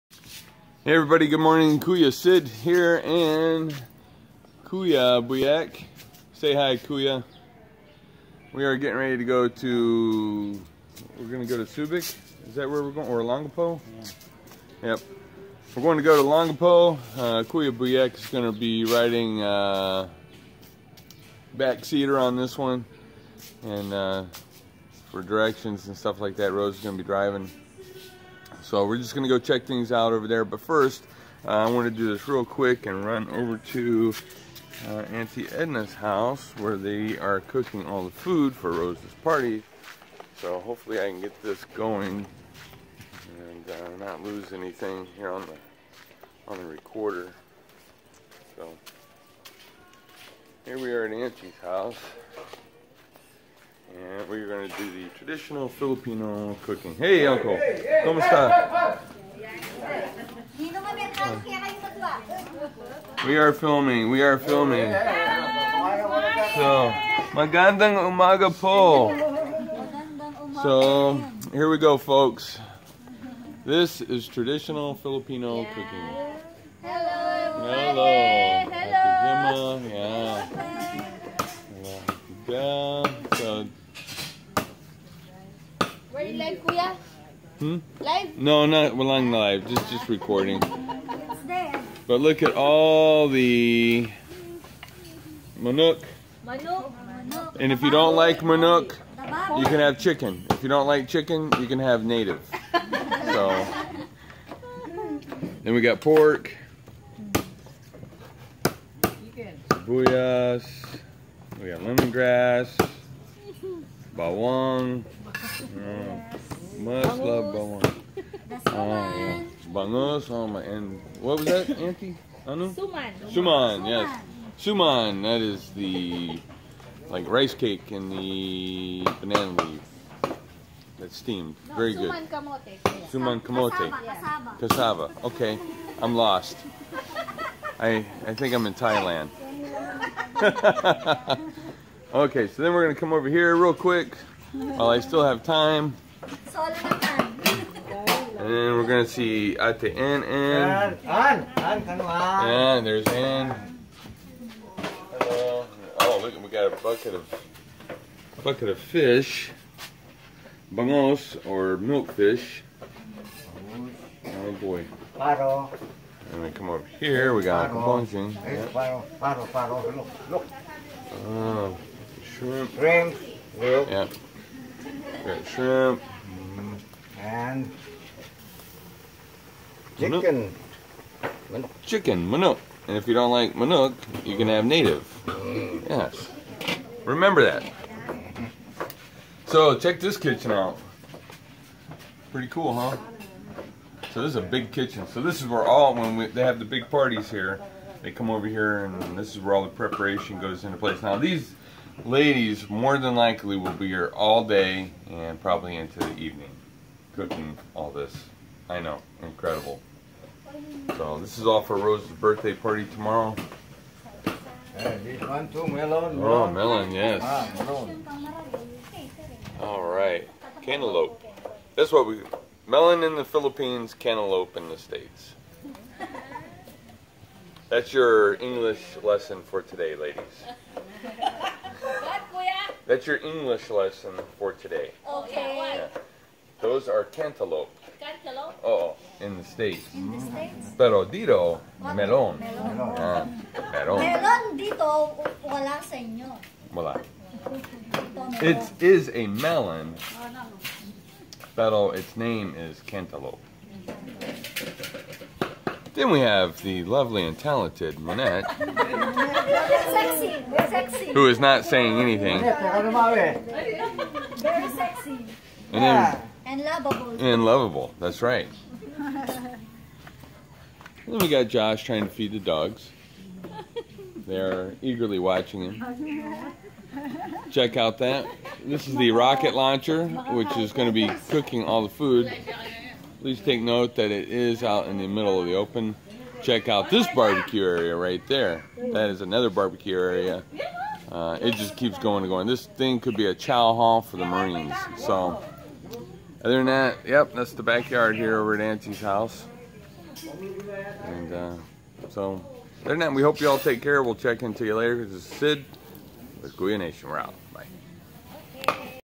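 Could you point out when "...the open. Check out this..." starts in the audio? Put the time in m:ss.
4:45.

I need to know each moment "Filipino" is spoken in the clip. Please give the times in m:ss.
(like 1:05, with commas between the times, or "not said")
0:55, 1:14.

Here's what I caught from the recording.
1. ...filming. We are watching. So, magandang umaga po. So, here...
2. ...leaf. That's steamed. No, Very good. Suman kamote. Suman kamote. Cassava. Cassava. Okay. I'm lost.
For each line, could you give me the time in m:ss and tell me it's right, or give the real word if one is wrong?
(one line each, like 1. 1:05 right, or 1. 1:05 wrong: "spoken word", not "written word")
1. 1:03 wrong: "filming", not "watching"
2. 2:09 right.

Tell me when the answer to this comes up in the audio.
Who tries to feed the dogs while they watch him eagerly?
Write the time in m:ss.
4:31.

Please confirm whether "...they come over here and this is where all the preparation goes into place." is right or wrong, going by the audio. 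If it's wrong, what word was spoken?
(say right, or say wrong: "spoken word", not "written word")
right.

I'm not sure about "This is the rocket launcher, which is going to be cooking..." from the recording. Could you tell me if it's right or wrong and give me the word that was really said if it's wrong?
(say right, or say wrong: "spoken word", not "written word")
right.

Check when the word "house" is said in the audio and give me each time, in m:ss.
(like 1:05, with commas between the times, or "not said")
0:35, 0:51, 4:59.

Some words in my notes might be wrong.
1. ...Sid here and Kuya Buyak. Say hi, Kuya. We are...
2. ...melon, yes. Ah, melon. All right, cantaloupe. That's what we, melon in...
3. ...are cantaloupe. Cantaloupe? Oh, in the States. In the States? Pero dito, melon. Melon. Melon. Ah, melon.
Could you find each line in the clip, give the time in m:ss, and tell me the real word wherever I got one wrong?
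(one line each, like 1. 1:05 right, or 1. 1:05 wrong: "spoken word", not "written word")
1. 0:02 right
2. 3:36 right
3. 3:56 right.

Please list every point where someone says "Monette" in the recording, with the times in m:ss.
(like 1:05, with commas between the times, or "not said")
4:17.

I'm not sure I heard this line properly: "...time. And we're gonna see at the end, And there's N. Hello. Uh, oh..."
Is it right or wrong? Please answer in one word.
right.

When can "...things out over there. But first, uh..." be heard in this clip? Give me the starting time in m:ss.
0:29.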